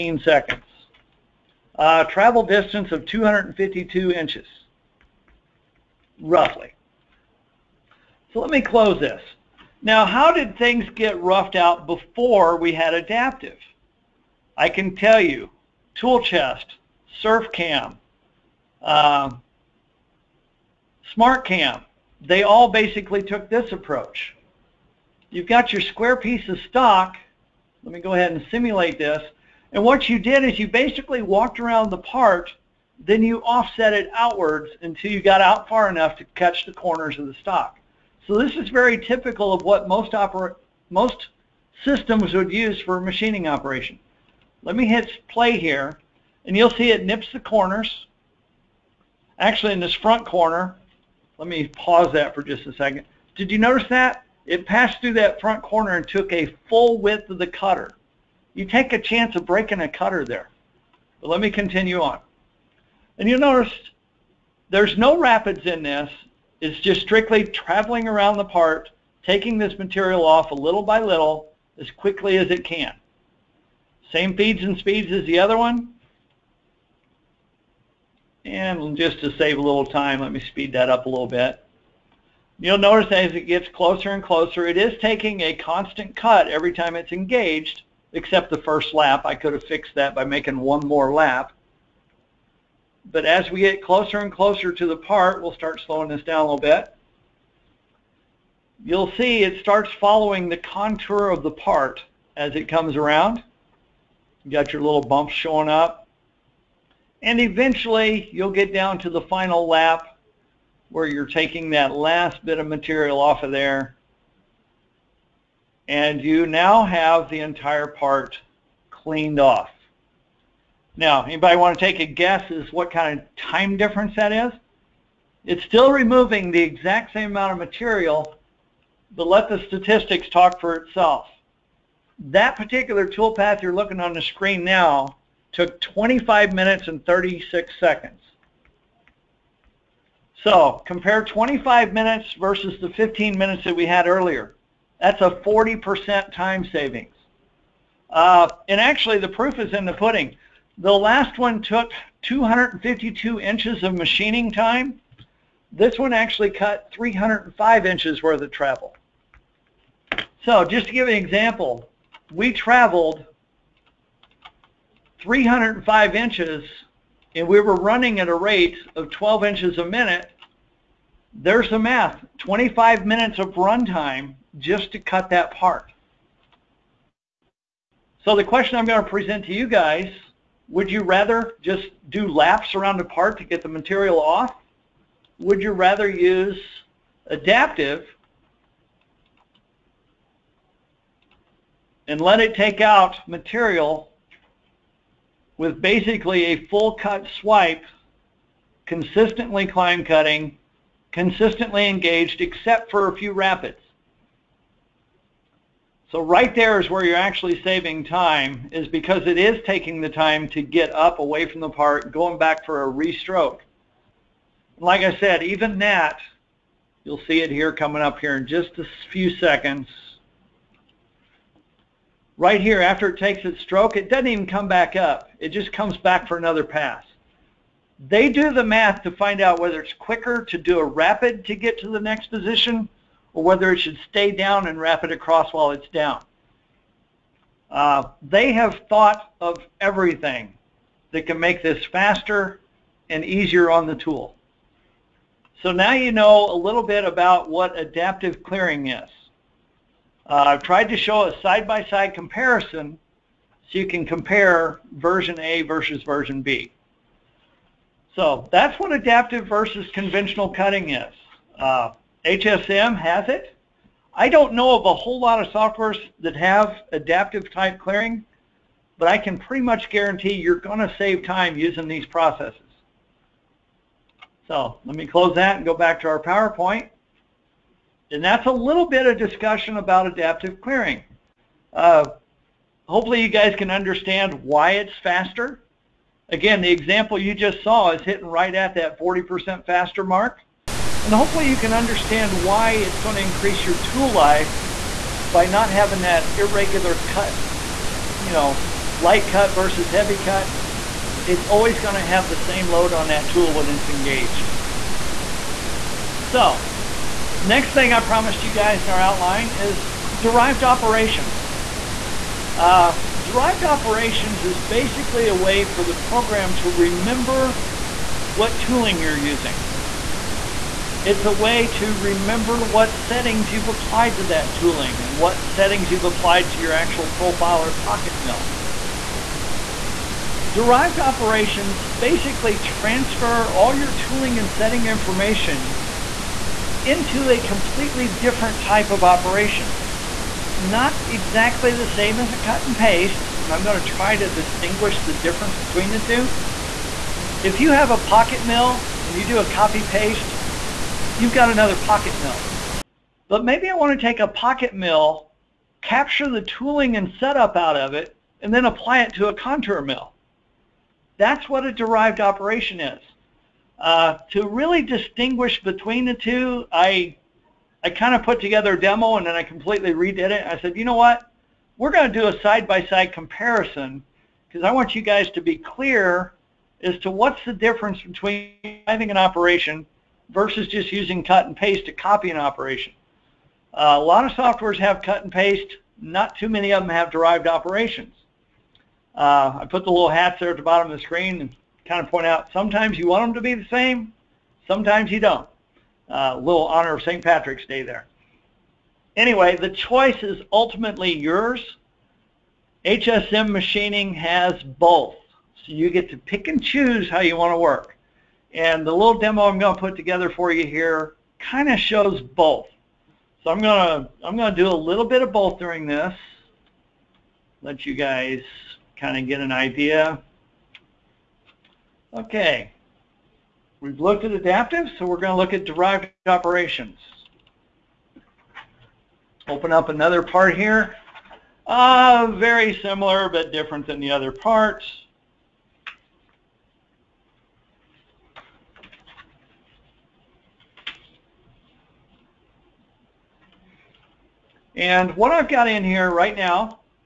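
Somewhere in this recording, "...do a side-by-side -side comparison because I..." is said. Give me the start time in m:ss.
6:12.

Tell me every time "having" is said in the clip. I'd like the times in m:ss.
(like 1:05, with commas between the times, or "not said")
4:55, 6:18.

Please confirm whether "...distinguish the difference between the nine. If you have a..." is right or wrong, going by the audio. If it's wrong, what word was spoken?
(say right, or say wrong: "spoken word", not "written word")
wrong: "two", not "nine".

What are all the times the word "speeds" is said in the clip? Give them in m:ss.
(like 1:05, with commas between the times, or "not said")
1:14, 1:20.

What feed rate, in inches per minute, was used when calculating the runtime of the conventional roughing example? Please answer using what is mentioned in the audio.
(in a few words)
12 inches a minute.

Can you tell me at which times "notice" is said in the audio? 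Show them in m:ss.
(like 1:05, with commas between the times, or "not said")
0:53, 1:03, 1:22.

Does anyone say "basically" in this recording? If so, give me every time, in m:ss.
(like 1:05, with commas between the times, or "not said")
0:22, 0:30, 3:15, 5:14, 5:31.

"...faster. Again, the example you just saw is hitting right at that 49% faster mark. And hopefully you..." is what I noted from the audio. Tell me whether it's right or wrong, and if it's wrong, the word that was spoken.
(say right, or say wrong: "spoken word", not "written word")
wrong: "40", not "49".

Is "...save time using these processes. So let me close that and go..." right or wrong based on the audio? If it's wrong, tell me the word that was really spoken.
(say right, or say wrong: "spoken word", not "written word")
right.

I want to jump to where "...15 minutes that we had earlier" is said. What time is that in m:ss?
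2:22.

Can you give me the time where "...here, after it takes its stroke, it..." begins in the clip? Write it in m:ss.
3:42.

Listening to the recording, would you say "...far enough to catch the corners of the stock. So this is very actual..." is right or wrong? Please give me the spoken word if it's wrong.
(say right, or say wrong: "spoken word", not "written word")
wrong: "typical", not "actual".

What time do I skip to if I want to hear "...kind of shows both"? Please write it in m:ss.
6:51.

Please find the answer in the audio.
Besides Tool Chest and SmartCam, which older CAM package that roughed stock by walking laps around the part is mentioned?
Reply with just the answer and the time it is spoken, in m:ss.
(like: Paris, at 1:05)
SurfCam, at 0:17.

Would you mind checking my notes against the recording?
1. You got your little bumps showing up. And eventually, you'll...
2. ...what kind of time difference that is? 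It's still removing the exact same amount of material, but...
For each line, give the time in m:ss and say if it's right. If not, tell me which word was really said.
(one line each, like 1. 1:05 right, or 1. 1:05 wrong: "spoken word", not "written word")
1. 1:44 right
2. 2:02 right.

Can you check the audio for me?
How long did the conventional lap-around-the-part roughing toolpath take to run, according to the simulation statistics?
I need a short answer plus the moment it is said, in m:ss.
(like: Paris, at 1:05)
25 minutes and 36 seconds, at 2:15.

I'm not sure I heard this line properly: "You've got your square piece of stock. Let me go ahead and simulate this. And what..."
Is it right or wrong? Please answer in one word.
right.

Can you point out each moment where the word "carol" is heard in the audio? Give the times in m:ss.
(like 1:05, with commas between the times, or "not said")
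not said.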